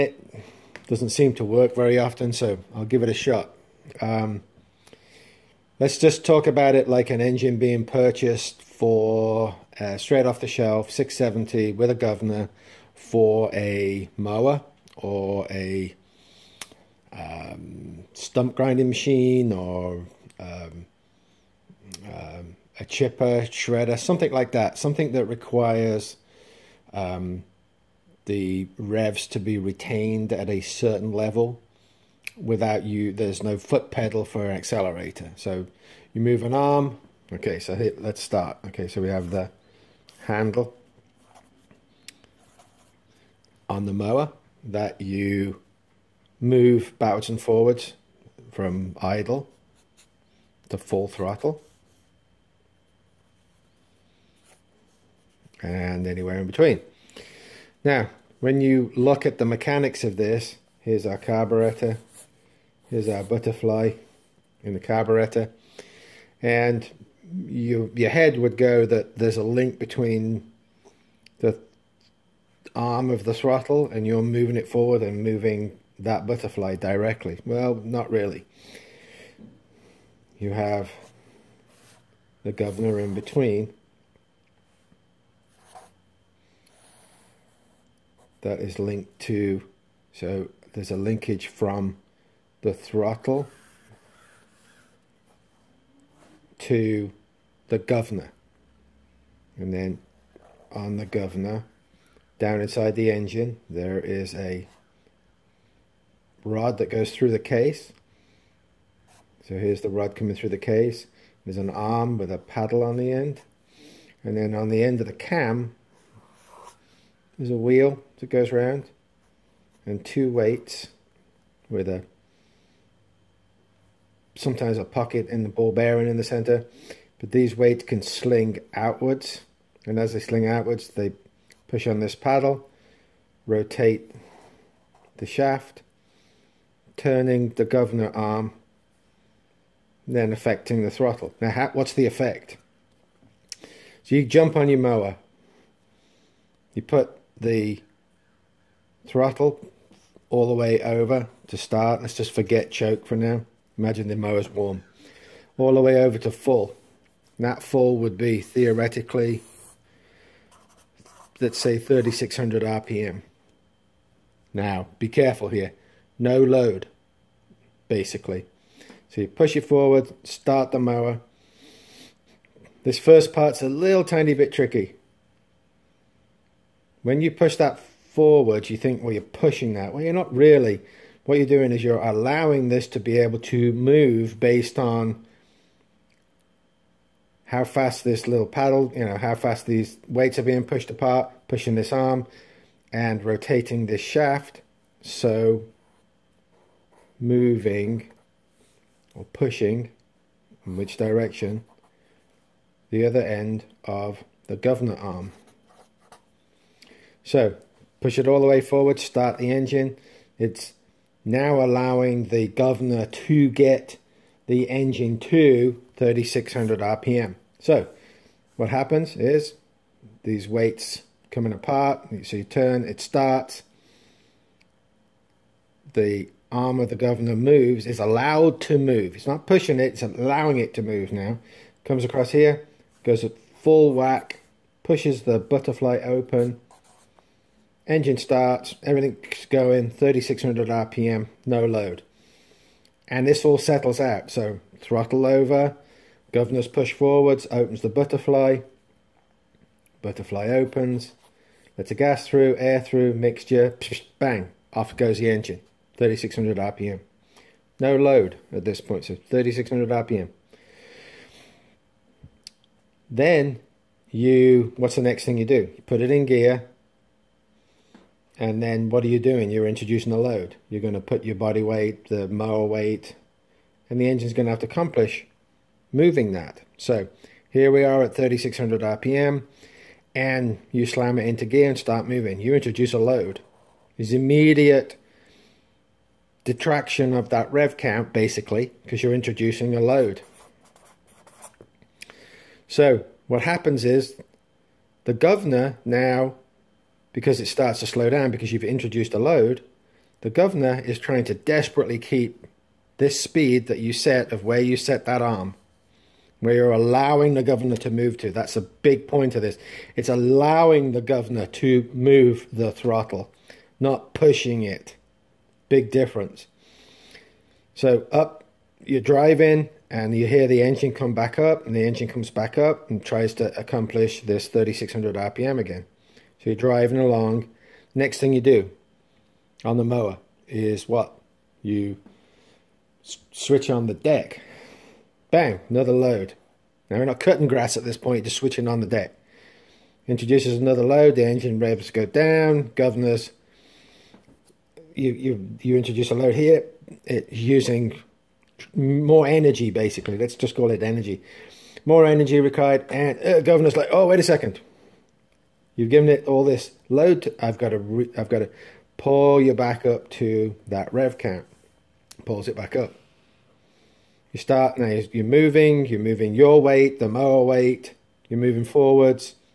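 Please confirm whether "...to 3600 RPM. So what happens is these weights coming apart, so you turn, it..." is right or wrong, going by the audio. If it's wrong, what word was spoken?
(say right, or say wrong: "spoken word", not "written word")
right.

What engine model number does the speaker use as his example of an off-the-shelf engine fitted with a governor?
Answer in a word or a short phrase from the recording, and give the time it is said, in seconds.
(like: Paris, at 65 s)
670, at 10 s.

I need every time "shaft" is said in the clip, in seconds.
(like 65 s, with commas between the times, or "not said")
135 s, 194 s.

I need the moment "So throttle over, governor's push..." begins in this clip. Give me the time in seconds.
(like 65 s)
244 s.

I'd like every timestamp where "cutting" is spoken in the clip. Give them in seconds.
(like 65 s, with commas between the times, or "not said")
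337 s.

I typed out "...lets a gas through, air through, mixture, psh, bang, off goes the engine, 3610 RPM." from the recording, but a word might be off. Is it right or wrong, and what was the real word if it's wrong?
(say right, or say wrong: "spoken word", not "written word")
wrong: "3600", not "3610".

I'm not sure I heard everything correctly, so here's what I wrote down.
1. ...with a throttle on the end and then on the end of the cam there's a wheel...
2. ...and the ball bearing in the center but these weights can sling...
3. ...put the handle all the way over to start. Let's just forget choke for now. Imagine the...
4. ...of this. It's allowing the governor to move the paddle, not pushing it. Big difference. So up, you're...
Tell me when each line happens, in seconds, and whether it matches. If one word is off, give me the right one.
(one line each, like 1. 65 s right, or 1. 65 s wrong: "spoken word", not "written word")
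1. 112 s wrong: "paddle", not "throttle"
2. 125 s right
3. 146 s wrong: "throttle", not "handle"
4. 309 s wrong: "throttle", not "paddle".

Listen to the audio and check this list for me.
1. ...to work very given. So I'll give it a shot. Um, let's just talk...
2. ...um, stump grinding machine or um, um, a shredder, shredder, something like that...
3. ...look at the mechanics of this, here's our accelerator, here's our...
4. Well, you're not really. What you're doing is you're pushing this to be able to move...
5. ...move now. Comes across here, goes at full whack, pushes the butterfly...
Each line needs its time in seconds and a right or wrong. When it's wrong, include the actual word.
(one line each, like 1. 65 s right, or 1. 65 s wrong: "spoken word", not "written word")
1. 1 s wrong: "often", not "given"
2. 17 s wrong: "chipper", not "shredder"
3. 58 s wrong: "carburetor", not "accelerator"
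4. 179 s wrong: "allowing", not "pushing"
5. 230 s right.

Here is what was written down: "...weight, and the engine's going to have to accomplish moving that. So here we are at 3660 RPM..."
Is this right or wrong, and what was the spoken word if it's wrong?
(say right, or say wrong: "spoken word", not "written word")
wrong: "3600", not "3660".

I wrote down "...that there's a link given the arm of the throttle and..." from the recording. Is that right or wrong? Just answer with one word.
wrong.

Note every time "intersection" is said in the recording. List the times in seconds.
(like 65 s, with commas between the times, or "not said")
not said.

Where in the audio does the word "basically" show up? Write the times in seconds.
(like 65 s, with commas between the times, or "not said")
167 s, 288 s, 349 s.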